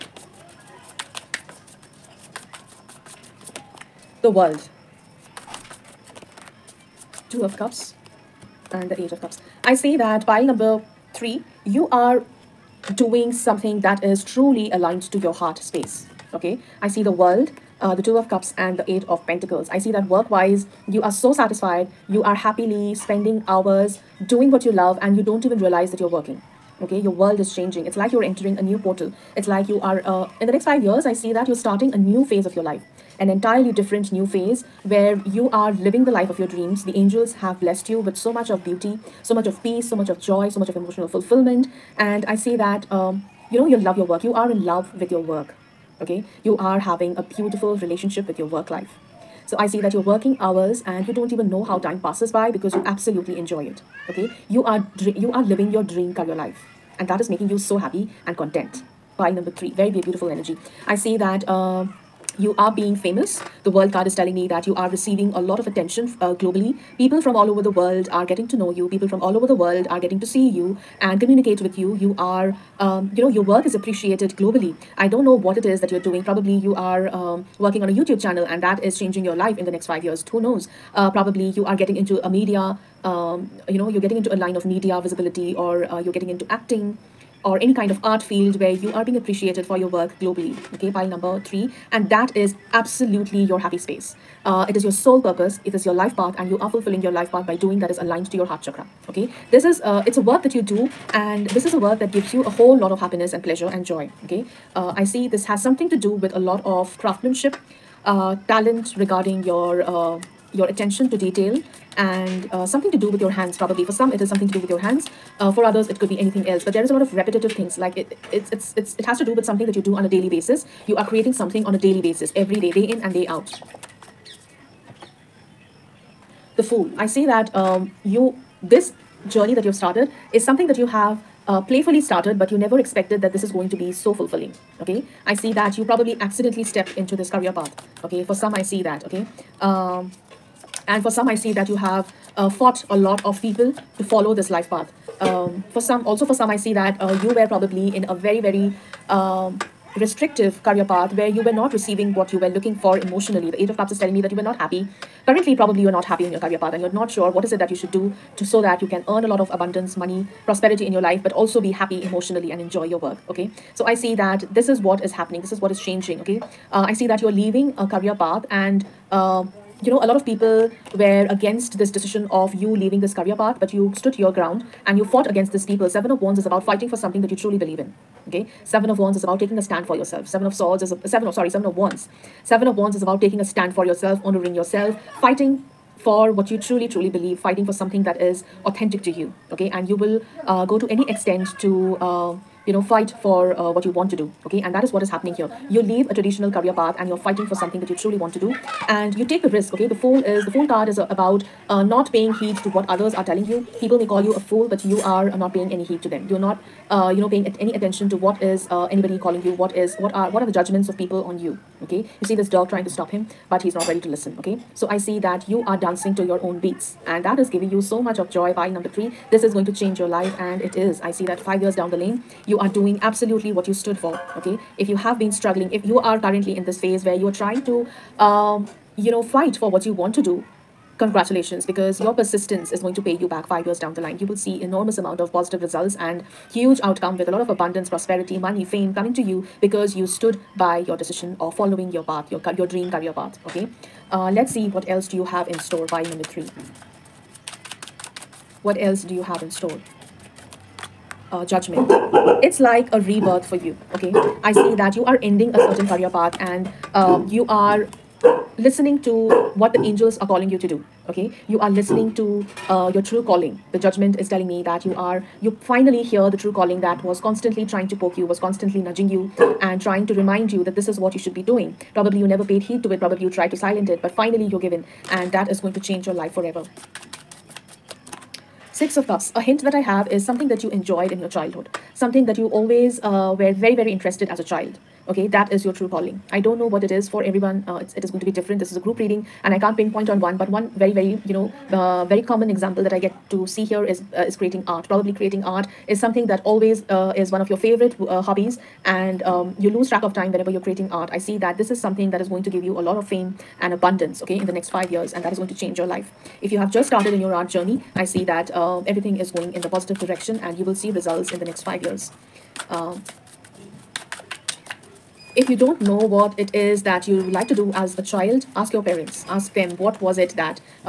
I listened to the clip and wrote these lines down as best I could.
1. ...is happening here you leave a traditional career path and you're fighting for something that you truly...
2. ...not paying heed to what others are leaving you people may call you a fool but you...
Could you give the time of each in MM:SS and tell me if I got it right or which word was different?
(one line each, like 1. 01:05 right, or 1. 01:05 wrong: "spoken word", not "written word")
1. 03:15 right
2. 03:21 wrong: "telling", not "leaving".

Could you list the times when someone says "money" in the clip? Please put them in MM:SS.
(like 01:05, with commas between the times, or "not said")
02:39, 03:58.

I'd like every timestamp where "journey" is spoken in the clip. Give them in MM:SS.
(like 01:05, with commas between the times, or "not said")
02:09, 05:07.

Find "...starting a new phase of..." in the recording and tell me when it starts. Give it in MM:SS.
00:31.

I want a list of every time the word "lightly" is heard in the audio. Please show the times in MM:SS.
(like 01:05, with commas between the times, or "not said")
not said.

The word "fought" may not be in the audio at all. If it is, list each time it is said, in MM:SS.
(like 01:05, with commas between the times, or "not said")
02:22, 02:55.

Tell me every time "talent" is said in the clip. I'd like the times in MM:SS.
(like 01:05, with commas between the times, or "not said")
01:48.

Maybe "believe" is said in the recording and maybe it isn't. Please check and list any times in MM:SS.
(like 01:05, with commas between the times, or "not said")
02:57, 03:07.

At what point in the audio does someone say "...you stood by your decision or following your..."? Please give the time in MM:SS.
03:59.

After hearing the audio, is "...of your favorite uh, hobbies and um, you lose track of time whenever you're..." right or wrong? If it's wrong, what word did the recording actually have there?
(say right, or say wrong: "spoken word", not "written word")
right.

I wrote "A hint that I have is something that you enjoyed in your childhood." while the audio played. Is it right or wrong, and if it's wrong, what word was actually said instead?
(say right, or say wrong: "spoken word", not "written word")
right.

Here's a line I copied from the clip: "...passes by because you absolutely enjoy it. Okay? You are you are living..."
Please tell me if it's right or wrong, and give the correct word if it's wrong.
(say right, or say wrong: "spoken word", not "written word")
right.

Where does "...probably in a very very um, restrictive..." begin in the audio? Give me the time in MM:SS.
02:27.